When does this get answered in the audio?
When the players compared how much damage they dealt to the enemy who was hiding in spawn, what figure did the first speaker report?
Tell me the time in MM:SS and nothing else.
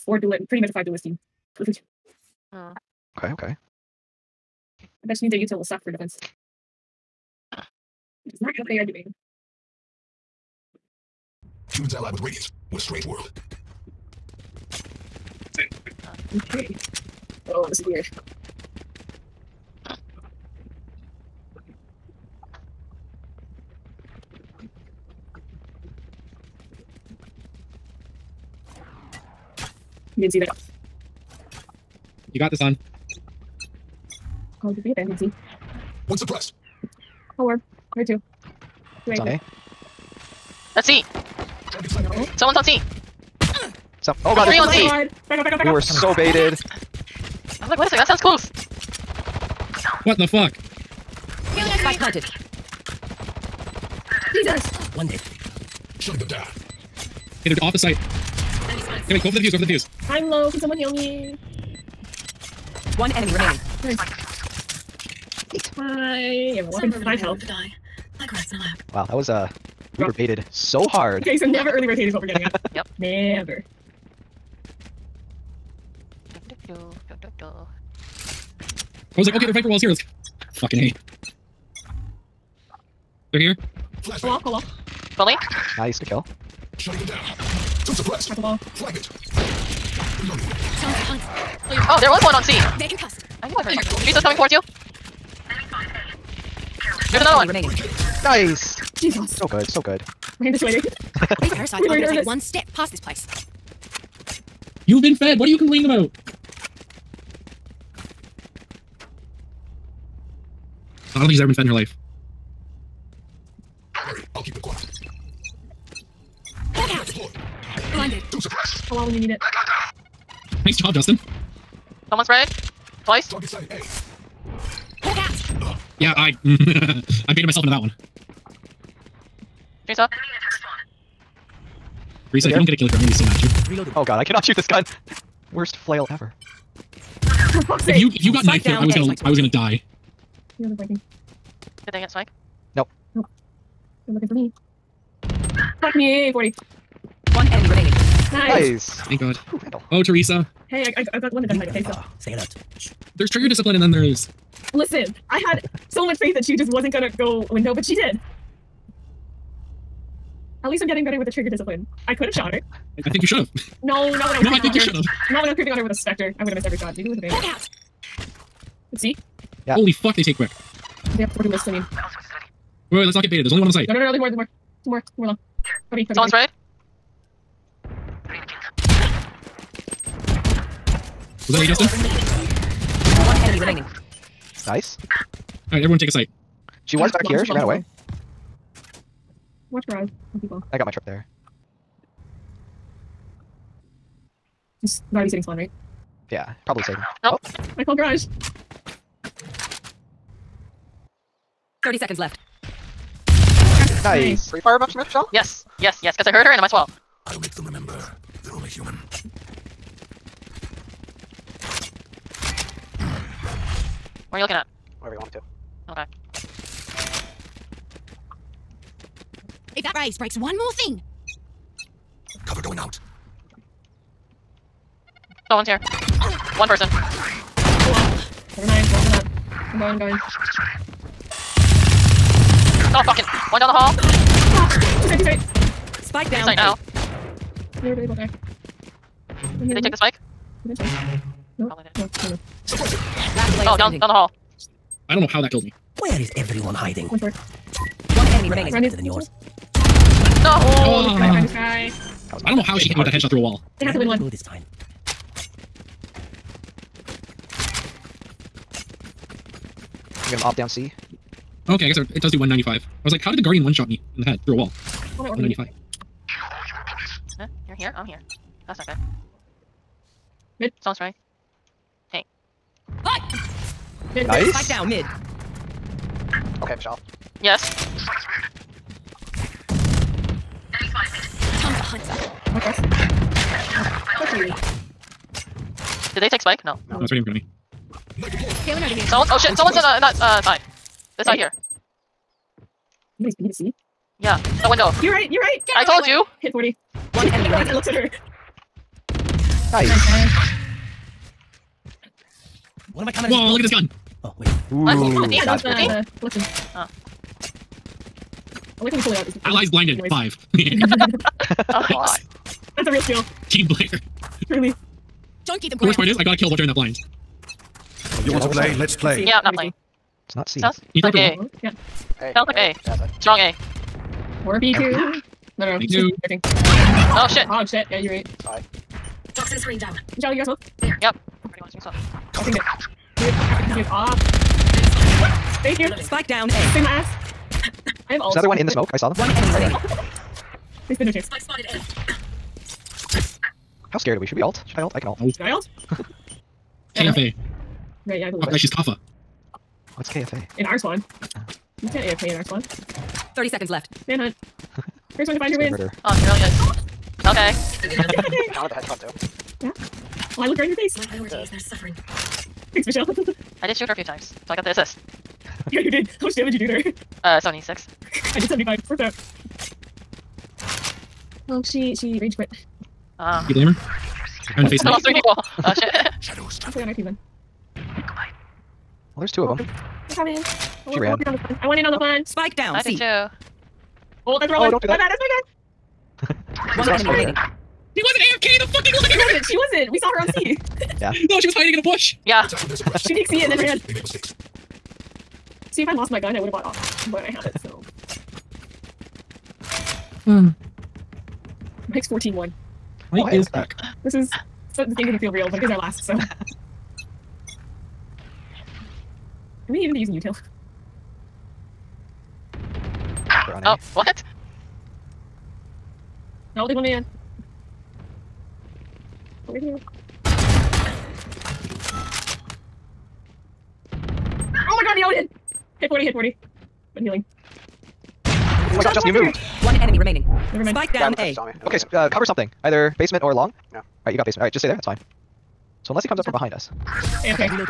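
06:07.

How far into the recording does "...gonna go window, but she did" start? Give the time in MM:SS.
02:36.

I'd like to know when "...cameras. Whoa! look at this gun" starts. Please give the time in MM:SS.
05:03.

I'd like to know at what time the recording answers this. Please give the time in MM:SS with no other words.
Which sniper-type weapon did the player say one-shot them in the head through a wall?
04:23.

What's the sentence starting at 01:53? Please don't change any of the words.
Don't worry, I'll keep them quiet.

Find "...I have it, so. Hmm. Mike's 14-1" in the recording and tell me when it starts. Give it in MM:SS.
06:37.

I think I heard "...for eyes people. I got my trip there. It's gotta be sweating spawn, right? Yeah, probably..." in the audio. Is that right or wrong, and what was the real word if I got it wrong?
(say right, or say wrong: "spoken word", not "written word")
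wrong: "sitting", not "sweating".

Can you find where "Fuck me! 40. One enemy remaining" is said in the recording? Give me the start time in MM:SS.
02:25.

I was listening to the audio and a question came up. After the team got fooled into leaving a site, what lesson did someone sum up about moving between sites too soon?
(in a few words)
Never early rotate.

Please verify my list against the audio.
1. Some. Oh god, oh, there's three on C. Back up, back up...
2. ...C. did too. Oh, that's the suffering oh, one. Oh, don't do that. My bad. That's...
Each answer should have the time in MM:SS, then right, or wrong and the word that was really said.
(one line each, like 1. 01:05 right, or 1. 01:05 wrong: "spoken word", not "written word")
1. 00:44 right
2. 06:22 wrong: "wrong", not "suffering".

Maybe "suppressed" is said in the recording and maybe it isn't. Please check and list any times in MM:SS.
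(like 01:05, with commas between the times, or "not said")
00:36, 01:27, 01:58, 06:32.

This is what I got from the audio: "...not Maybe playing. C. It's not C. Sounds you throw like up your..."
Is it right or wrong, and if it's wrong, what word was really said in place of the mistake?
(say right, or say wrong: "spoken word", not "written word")
right.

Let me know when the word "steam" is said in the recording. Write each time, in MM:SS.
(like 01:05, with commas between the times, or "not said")
not said.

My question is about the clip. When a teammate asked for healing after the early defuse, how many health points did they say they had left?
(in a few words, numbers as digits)
5.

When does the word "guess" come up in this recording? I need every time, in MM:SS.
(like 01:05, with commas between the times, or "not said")
04:21.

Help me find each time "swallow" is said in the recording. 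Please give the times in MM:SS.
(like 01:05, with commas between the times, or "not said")
03:26.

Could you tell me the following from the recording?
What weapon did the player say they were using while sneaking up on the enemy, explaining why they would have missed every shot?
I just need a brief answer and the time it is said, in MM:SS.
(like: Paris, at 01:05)
Spectre, at 02:45.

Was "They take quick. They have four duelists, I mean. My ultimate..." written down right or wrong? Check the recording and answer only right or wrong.
right.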